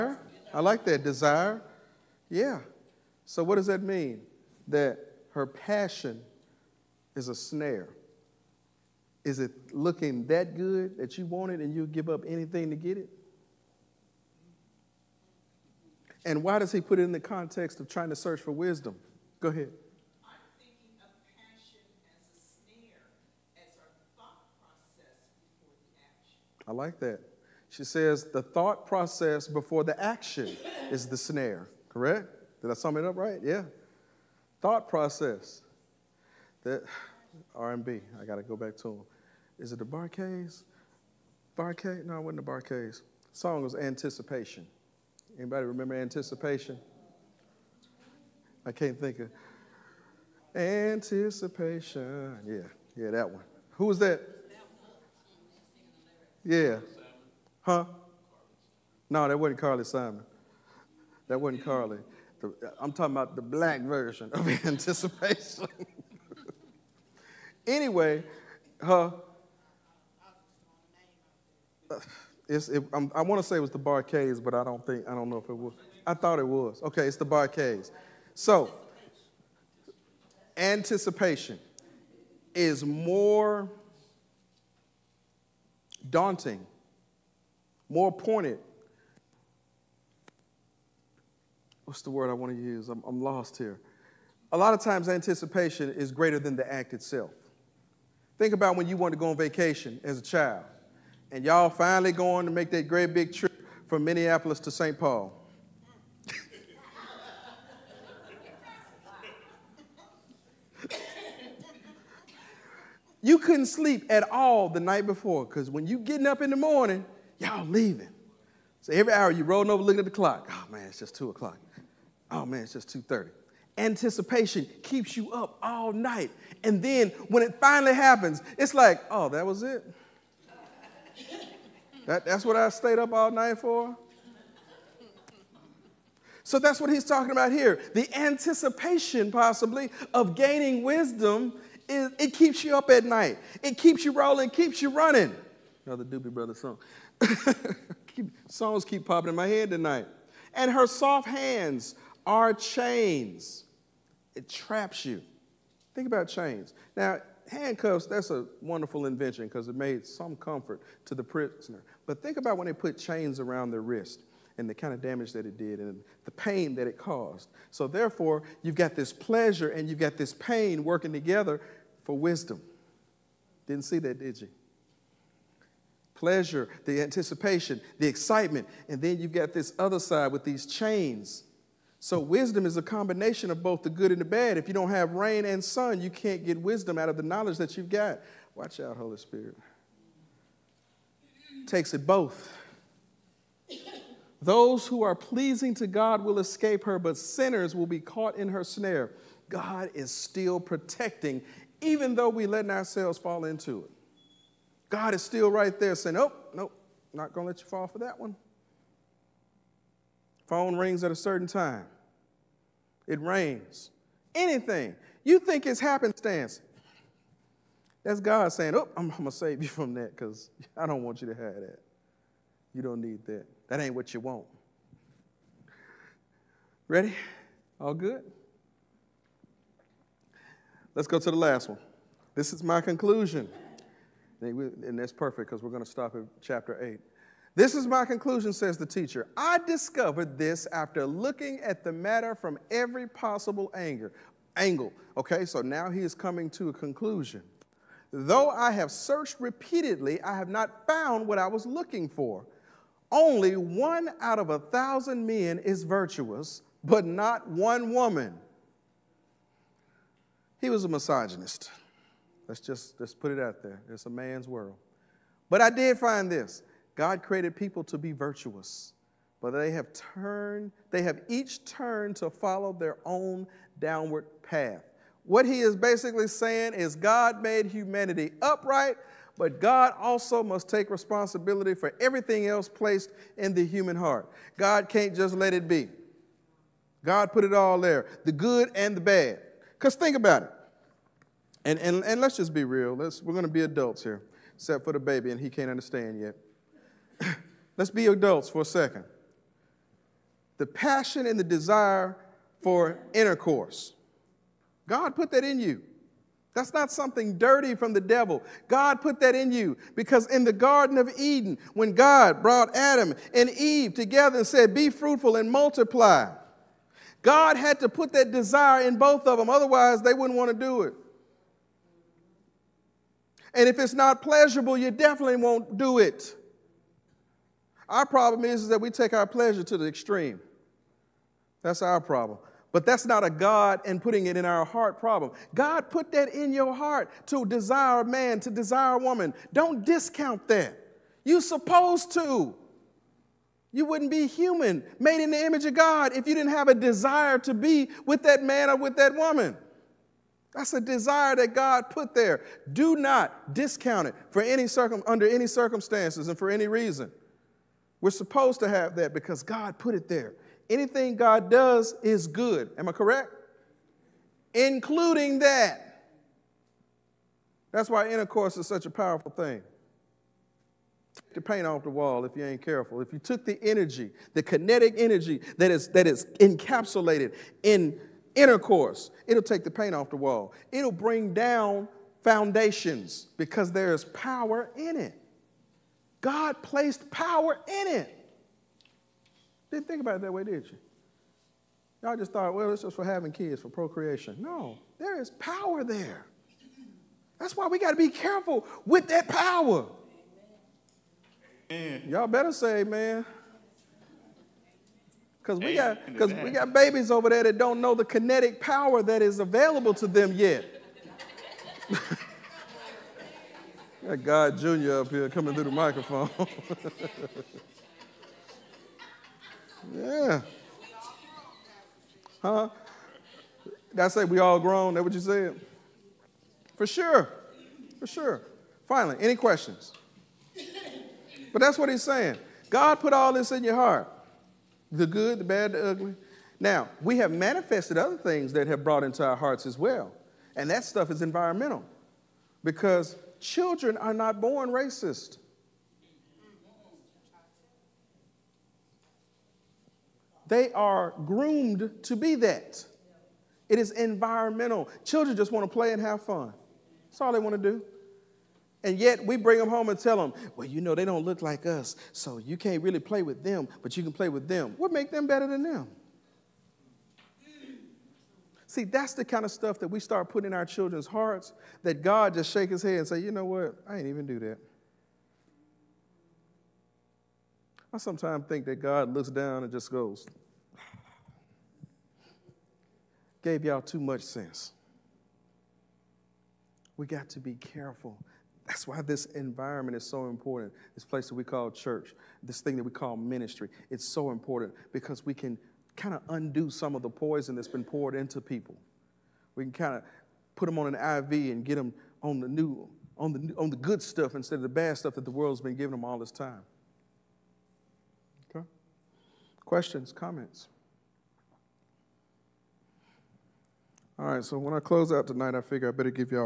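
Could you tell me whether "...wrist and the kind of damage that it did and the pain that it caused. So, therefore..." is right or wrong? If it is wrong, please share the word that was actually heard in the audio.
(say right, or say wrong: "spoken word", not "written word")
right.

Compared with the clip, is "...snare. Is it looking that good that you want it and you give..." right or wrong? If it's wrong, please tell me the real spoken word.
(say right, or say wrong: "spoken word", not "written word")
right.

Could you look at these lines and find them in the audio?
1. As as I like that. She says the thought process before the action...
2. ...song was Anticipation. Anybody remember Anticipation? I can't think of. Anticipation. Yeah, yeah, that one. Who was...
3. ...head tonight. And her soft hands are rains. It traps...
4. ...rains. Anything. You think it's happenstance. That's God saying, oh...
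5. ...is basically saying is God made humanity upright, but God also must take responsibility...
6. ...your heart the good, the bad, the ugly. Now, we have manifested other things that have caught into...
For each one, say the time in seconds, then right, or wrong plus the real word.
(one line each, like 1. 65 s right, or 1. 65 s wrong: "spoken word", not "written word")
1. 23 s right
2. 43 s right
3. 149 s wrong: "chains", not "rains"
4. 213 s right
5. 275 s right
6. 433 s wrong: "brought", not "caught".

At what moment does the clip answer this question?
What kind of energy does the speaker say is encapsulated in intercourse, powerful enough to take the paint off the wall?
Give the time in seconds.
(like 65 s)
374 s.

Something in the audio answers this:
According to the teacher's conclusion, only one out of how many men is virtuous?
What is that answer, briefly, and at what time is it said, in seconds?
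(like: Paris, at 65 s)
1,000, at 254 s.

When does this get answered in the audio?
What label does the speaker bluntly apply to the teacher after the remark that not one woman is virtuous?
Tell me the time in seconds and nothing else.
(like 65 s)
260 s.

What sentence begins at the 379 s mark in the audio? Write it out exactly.
It'll take the paint off the wall.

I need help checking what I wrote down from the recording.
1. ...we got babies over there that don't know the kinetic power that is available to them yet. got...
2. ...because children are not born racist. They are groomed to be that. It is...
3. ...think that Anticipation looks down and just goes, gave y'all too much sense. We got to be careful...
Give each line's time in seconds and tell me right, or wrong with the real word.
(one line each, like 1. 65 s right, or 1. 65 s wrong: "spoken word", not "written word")
1. 406 s right
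2. 442 s right
3. 478 s wrong: "God", not "Anticipation".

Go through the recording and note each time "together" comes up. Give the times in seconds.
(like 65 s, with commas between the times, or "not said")
171 s, 313 s.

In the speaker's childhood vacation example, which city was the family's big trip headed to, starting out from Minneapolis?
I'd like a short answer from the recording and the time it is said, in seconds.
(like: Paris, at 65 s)
St. Paul, at 104 s.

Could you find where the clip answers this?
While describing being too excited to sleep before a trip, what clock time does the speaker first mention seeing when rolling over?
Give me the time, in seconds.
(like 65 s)
121 s.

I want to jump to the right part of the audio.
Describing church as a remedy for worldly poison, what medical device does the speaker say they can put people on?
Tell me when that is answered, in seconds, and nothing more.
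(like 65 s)
500 s.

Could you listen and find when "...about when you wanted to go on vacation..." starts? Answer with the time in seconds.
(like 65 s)
98 s.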